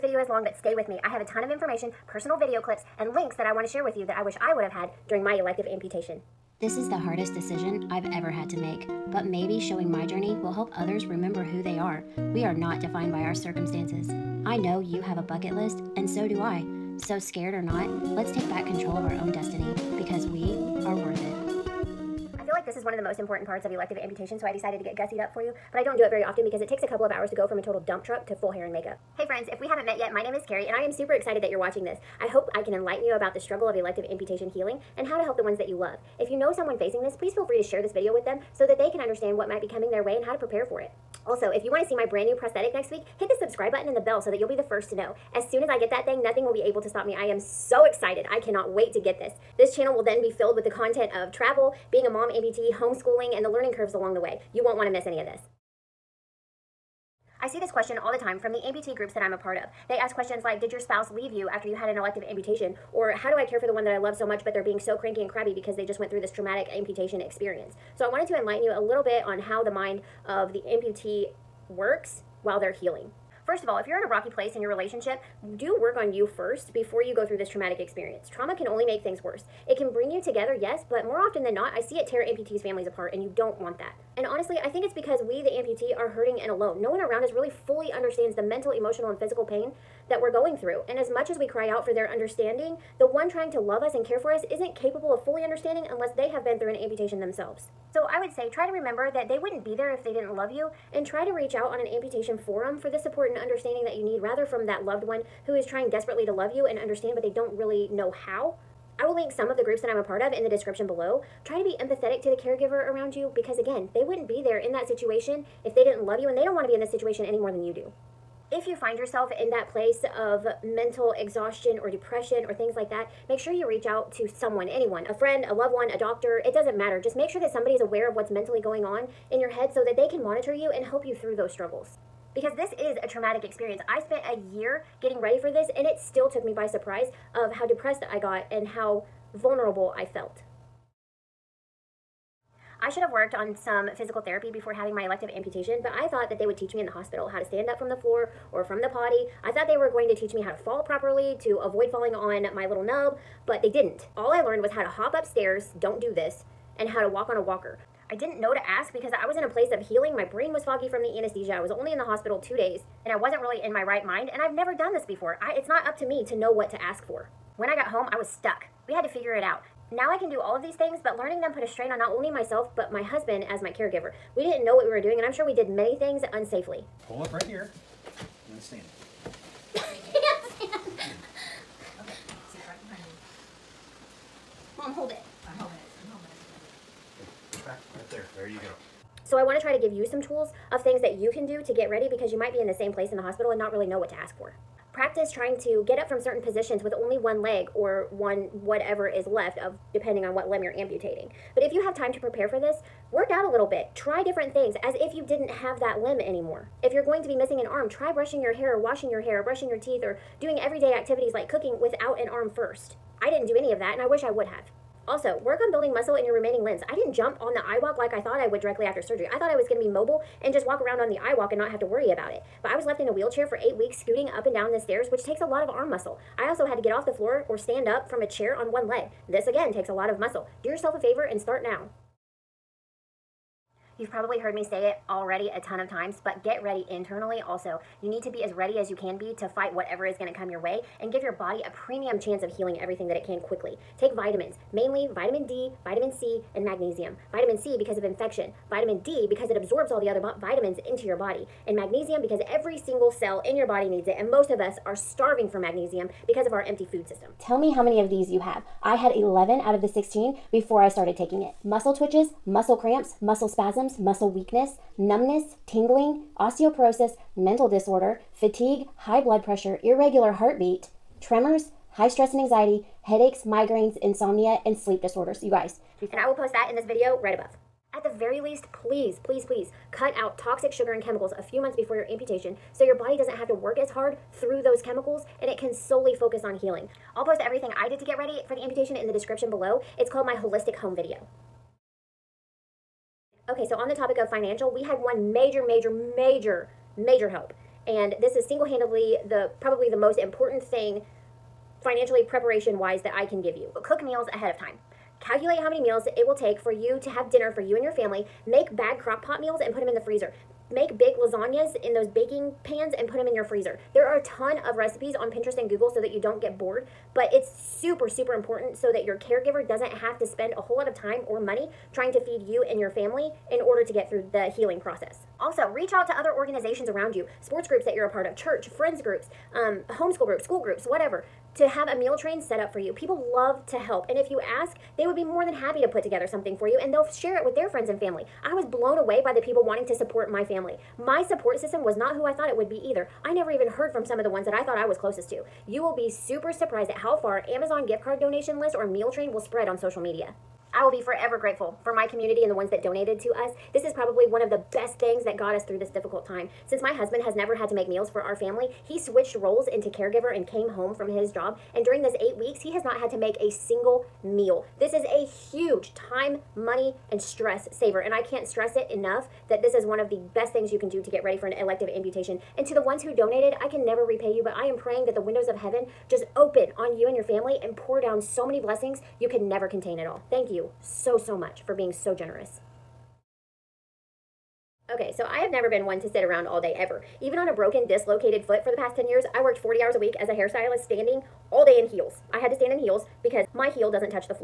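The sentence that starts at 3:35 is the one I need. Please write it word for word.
Also, work on building muscle in your remaining limbs.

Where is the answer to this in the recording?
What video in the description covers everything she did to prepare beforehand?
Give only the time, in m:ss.
4:50.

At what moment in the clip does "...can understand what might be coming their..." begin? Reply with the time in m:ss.
0:38.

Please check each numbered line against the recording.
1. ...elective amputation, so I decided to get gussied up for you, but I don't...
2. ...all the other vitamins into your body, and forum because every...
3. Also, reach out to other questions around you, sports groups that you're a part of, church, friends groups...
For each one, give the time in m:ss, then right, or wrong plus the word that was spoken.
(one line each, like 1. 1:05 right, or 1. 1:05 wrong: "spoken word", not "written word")
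1. 0:23 right
2. 4:09 wrong: "magnesium", not "forum"
3. 5:25 wrong: "organizations", not "questions".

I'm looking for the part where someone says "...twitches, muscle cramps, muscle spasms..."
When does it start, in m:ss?
4:21.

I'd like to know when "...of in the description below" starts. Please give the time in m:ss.
1:50.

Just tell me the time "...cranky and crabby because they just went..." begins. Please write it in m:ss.
1:04.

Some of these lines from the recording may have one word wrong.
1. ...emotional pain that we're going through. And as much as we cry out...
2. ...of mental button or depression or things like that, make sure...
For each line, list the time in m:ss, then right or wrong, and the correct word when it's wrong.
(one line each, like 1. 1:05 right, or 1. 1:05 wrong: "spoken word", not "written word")
1. 1:29 wrong: "physical", not "emotional"
2. 2:00 wrong: "exhaustion", not "button".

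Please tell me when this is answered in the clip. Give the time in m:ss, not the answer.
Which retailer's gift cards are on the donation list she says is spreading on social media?
5:47.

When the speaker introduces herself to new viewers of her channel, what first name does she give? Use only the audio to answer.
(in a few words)
Kerri.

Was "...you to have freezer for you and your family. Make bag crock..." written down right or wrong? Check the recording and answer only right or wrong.
wrong.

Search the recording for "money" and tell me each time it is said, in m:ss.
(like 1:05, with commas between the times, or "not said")
5:21, 6:06.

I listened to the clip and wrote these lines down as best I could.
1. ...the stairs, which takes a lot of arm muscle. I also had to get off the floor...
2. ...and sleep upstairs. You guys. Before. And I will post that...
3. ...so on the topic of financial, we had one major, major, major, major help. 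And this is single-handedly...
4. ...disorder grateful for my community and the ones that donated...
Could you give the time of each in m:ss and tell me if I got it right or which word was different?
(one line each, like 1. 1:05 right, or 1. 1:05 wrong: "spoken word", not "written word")
1. 3:44 right
2. 4:34 wrong: "disorders", not "upstairs"
3. 4:53 right
4. 5:51 wrong: "forever", not "disorder".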